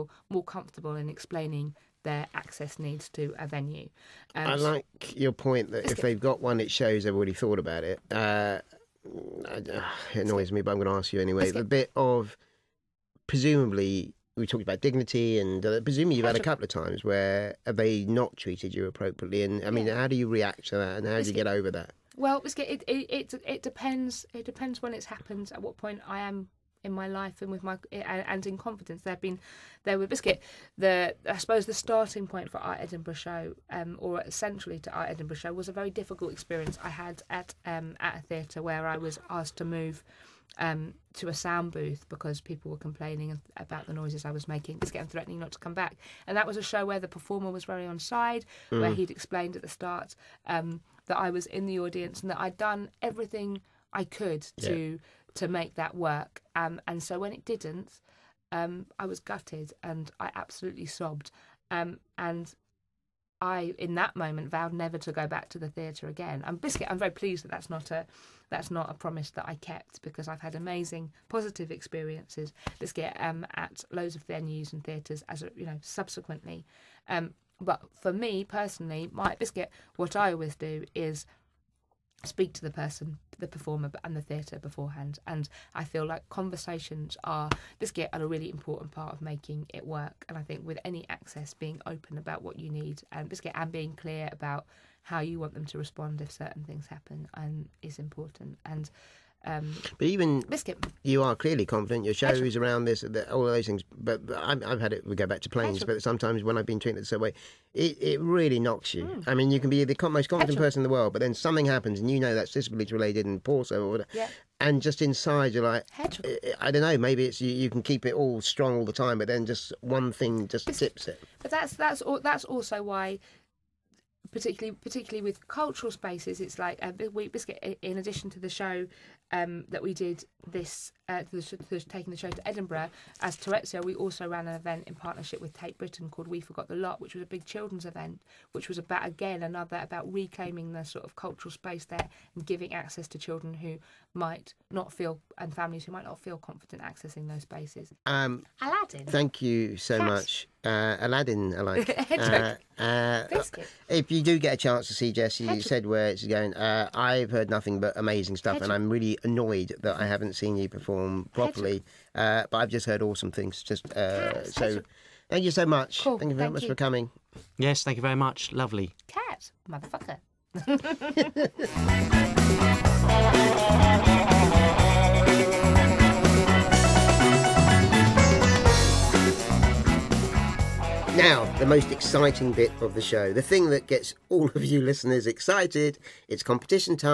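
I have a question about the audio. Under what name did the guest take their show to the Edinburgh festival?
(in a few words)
Touretteshero.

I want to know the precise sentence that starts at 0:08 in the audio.
Uh, uh it annoys me, but I'm going to ask you anyway.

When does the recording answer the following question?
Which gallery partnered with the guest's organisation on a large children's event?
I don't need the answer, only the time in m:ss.
2:15.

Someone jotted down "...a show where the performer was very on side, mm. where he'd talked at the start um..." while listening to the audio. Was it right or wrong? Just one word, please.
wrong.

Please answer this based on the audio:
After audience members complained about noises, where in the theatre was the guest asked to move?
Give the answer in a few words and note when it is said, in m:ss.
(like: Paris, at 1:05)
A sound booth, at 0:41.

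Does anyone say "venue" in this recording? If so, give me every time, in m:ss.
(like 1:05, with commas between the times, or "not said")
0:03, 1:14.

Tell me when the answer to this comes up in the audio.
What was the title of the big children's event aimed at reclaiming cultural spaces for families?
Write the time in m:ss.
2:16.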